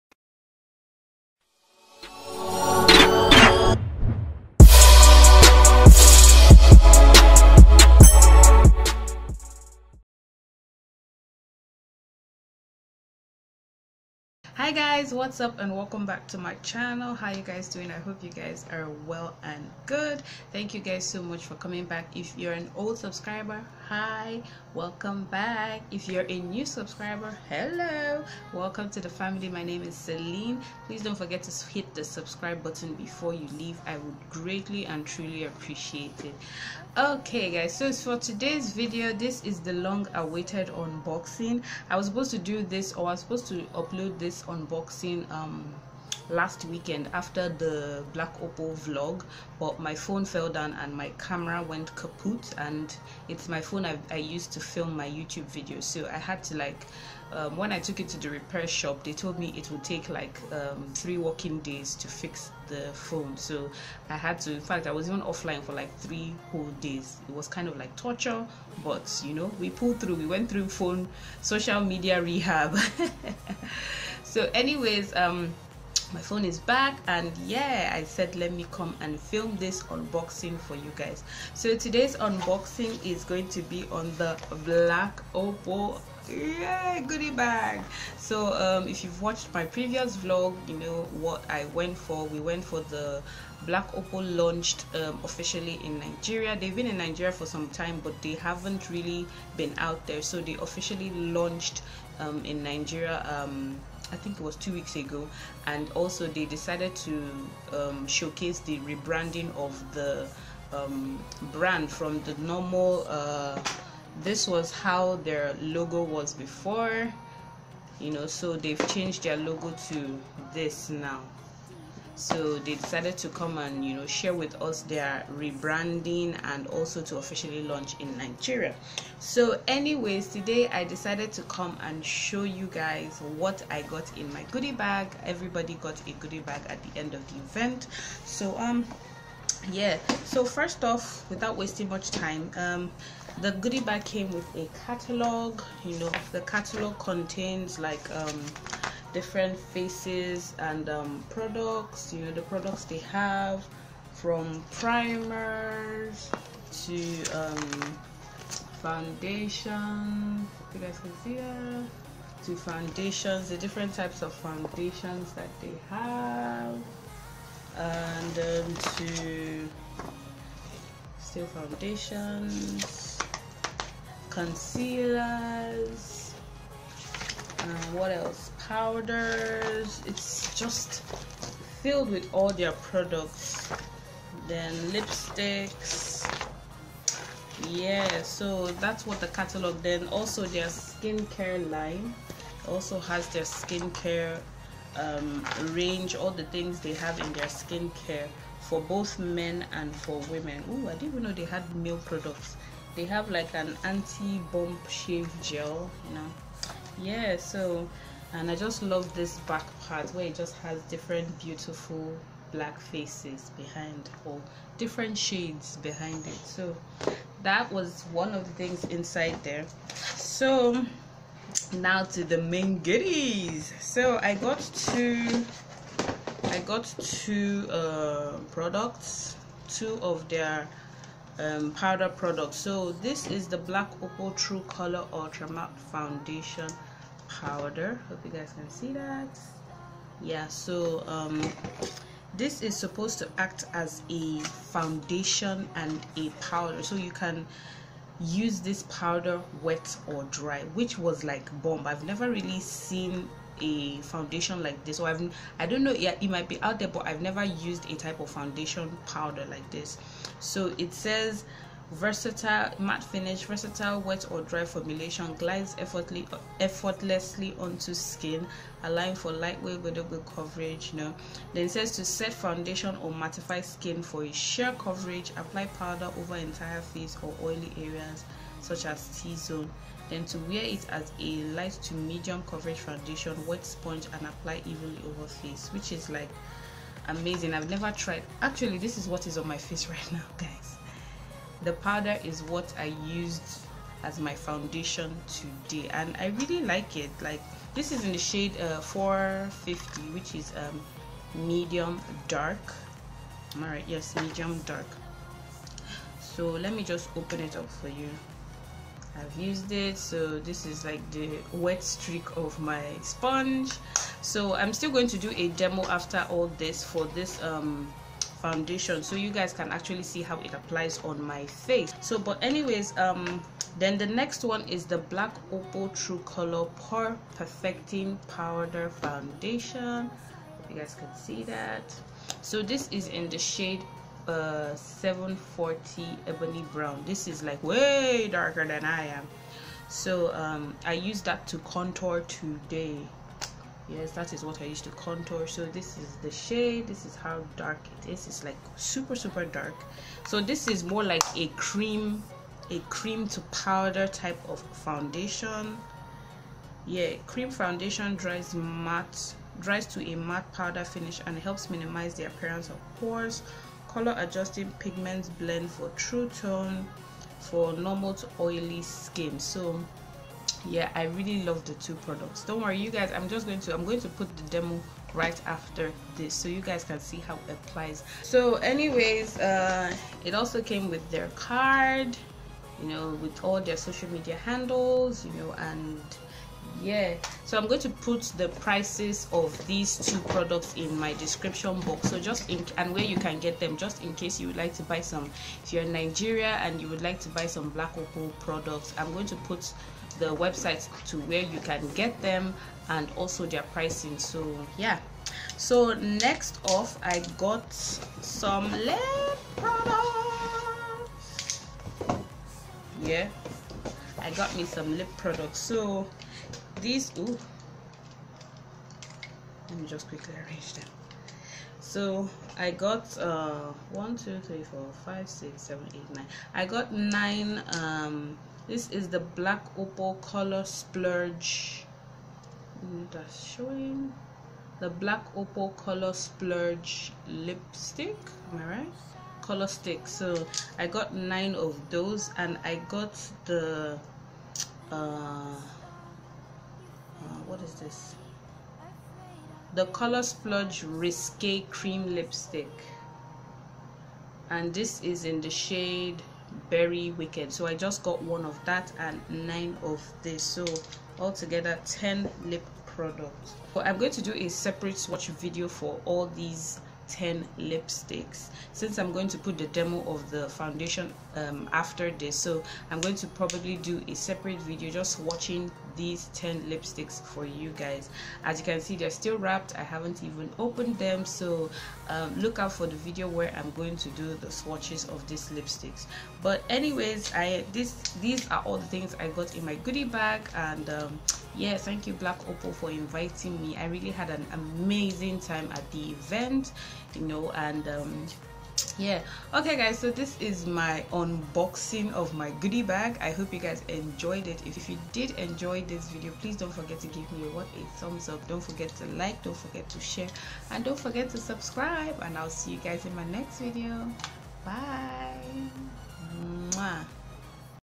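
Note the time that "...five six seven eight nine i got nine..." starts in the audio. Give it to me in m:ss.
7:05.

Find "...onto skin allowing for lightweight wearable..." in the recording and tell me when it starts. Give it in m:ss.
4:27.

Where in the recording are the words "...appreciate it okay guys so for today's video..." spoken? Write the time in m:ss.
0:35.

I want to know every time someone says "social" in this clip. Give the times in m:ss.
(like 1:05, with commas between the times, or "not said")
1:11, 6:23.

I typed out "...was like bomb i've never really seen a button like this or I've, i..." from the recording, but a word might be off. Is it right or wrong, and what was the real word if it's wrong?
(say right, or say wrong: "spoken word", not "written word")
wrong: "foundation", not "button".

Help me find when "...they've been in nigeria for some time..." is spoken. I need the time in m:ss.
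1:36.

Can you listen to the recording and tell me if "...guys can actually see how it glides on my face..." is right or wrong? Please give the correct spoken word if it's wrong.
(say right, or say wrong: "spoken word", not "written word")
wrong: "applies", not "glides".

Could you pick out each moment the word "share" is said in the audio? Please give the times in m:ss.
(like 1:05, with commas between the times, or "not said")
2:04, 8:29.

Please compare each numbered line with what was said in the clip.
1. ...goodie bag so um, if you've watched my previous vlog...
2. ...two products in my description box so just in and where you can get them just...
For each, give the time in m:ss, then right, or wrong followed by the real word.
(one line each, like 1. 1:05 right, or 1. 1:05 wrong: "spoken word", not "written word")
1. 1:27 right
2. 6:29 right.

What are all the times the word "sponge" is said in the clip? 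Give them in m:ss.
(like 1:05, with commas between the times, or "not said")
4:43, 5:13.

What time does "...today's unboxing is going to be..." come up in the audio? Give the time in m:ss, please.
1:21.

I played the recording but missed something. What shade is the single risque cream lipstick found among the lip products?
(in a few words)
Berry Wicked.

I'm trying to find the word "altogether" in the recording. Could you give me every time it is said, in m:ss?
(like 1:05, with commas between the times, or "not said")
7:41.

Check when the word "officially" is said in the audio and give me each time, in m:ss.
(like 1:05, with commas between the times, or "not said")
1:35, 1:40, 2:07.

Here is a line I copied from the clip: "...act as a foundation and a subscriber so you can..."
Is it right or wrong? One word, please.
wrong.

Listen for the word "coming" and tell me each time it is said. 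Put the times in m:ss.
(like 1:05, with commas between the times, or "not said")
0:21.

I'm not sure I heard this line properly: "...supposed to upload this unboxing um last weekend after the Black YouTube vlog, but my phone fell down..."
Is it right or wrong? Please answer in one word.
wrong.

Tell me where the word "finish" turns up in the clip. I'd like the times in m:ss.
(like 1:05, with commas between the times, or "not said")
4:23, 6:00.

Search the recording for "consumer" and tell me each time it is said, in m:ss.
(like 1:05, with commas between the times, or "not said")
not said.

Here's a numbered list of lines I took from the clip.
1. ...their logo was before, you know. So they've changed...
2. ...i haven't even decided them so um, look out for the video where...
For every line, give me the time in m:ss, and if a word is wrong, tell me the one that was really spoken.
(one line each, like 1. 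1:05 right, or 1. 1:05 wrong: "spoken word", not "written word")
1. 1:55 right
2. 7:59 wrong: "opened", not "decided".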